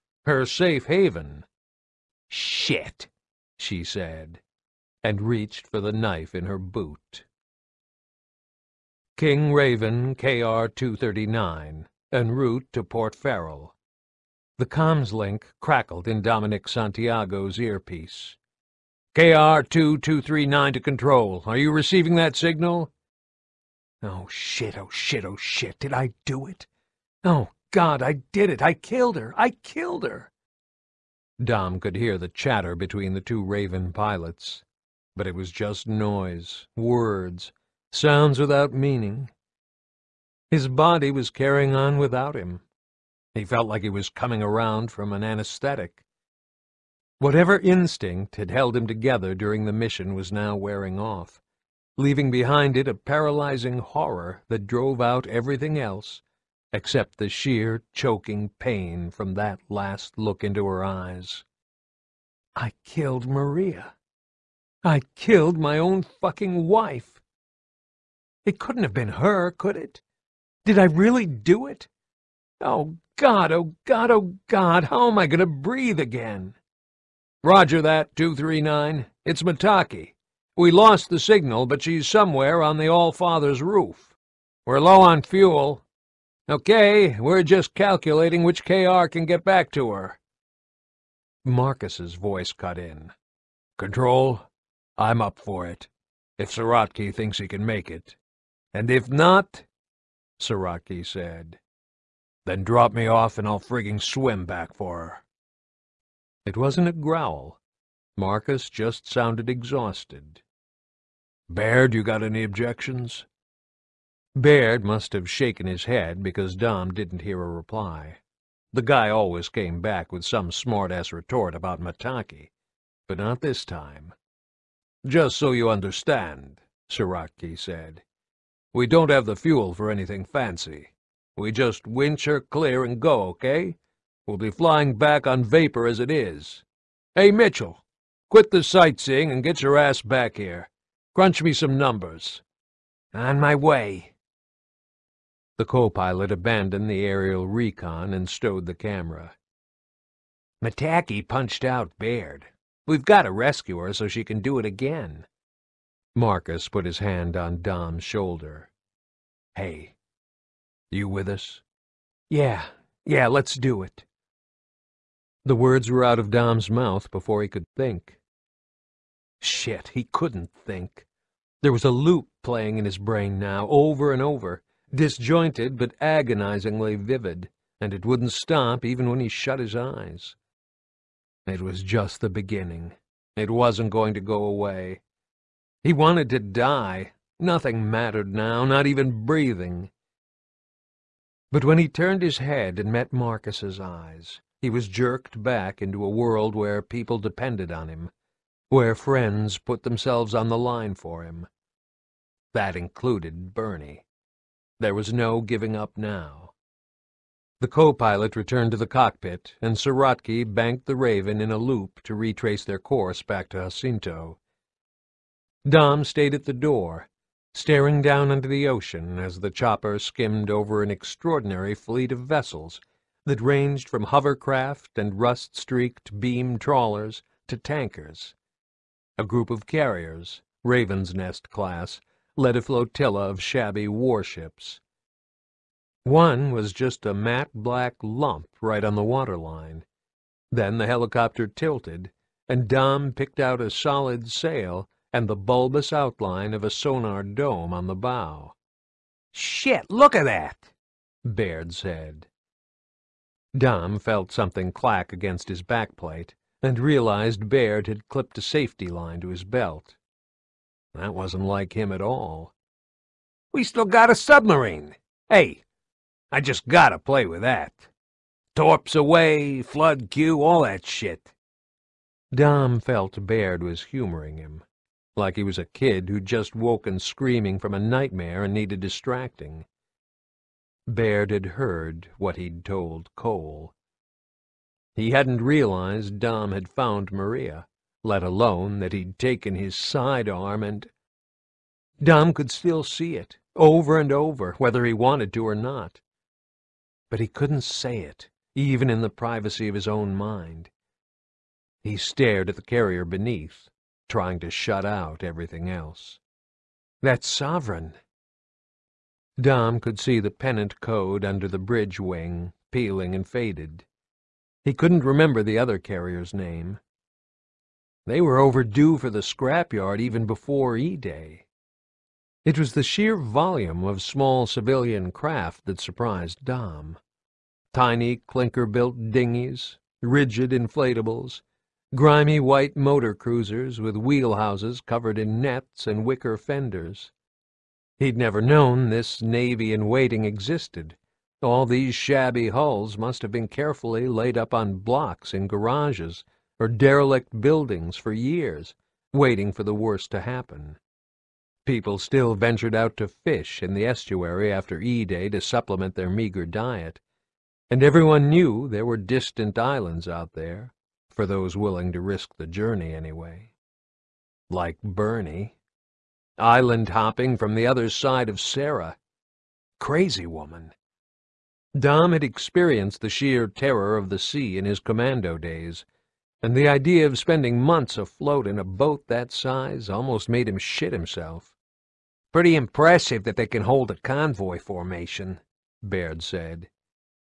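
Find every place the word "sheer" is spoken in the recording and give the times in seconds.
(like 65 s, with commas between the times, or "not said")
57 s, 322 s, 373 s.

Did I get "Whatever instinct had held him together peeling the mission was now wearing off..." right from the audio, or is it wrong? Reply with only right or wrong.
wrong.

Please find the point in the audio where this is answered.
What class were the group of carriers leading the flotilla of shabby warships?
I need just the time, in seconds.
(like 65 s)
230 s.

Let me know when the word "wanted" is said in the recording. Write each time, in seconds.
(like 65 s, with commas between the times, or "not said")
185 s, 294 s.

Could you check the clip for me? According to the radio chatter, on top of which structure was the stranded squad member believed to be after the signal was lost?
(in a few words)
the All-Father.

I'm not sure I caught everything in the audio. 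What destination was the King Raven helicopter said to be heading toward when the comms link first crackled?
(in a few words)
Port Farrell.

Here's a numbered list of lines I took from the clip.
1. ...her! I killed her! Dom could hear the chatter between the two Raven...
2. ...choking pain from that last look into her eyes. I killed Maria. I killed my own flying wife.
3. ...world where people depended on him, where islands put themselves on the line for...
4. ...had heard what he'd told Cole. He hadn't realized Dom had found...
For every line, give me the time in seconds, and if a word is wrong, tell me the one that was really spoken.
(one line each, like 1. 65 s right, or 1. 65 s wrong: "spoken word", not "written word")
1. 29 s right
2. 57 s wrong: "fucking", not "flying"
3. 196 s wrong: "friends", not "islands"
4. 281 s right.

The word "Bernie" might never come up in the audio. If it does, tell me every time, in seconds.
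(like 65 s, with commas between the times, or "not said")
203 s, 364 s.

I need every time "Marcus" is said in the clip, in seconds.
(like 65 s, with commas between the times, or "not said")
91 s, 108 s, 156 s, 193 s.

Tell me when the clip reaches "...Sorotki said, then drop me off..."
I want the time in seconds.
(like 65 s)
100 s.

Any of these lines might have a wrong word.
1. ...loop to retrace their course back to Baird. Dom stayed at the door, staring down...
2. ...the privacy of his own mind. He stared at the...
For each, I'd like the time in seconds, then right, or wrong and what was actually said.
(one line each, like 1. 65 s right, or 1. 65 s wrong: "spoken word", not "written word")
1. 211 s wrong: "Jacinto", not "Baird"
2. 299 s right.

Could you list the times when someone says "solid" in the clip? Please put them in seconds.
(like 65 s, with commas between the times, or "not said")
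243 s.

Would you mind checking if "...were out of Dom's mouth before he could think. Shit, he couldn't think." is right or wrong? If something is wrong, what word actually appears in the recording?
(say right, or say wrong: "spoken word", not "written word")
right.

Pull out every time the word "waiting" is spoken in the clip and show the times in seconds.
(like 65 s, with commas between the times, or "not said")
339 s, 349 s.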